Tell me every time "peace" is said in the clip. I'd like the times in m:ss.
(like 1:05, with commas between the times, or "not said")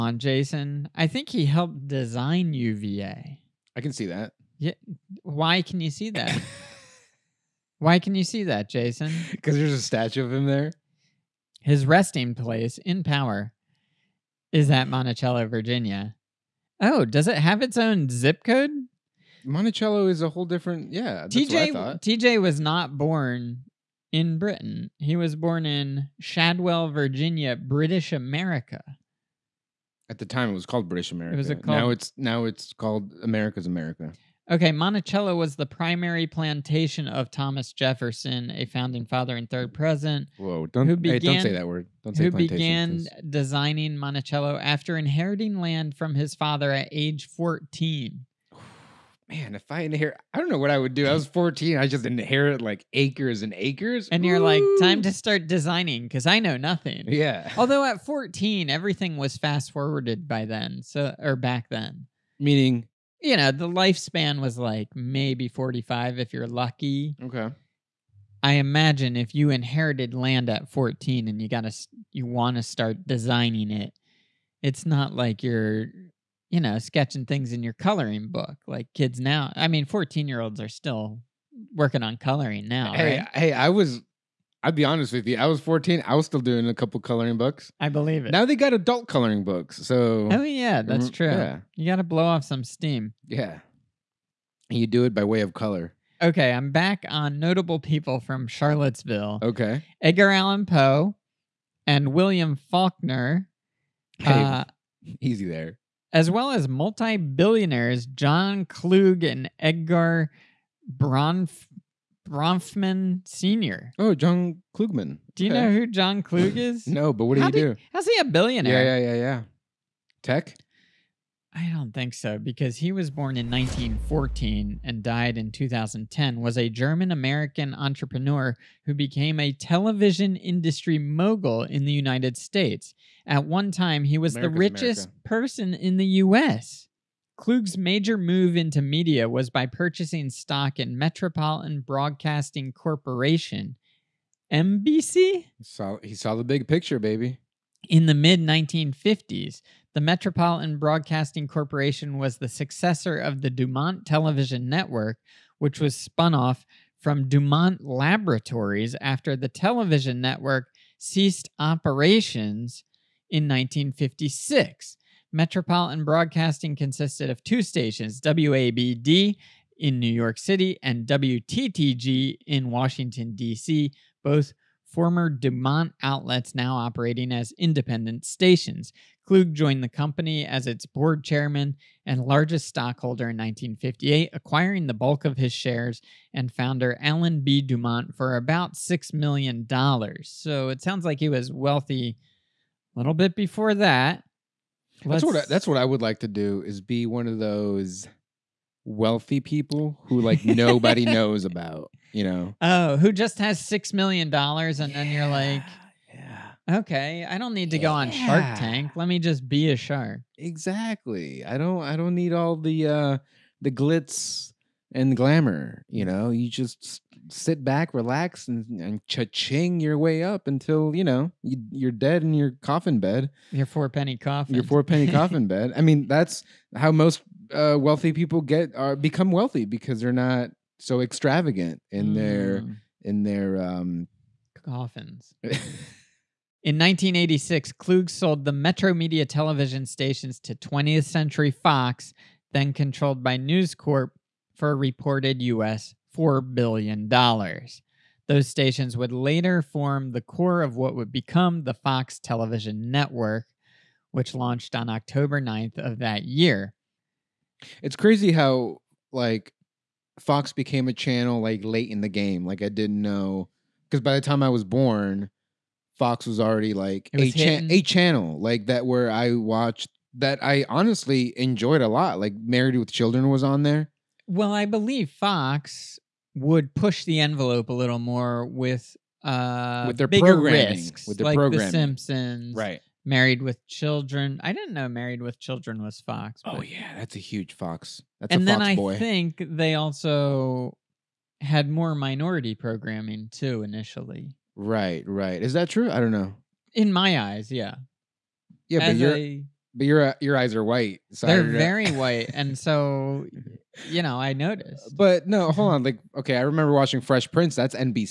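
not said.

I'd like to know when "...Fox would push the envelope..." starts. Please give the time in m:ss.
4:35.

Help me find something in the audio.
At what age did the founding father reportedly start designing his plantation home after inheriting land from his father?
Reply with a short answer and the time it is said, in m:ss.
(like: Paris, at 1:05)
14, at 0:46.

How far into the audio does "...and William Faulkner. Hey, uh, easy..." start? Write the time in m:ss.
1:41.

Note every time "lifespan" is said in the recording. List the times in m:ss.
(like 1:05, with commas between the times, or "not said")
1:03.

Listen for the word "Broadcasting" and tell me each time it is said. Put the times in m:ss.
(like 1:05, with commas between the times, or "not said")
2:21, 2:30, 2:46.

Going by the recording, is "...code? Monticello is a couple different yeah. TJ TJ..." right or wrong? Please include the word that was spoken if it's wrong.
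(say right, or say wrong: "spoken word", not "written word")
wrong: "whole", not "couple".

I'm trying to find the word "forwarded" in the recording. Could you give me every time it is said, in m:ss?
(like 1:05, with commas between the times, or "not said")
0:59.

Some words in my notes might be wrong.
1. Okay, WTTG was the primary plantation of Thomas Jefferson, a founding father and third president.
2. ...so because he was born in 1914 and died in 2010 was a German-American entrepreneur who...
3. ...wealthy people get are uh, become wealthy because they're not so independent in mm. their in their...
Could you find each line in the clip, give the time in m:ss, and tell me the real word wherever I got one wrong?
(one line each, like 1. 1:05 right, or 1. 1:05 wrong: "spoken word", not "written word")
1. 0:34 wrong: "Monticello", not "WTTG"
2. 2:02 right
3. 3:47 wrong: "extravagant", not "independent".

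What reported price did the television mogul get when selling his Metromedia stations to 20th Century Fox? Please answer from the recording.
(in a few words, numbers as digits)
$4 billion.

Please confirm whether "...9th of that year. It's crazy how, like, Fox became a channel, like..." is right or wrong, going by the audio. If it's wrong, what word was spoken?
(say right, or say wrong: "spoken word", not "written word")
right.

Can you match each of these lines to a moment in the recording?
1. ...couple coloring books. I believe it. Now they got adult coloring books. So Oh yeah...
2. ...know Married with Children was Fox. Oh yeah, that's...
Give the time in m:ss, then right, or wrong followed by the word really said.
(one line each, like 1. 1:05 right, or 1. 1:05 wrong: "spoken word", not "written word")
1. 1:26 right
2. 4:44 right.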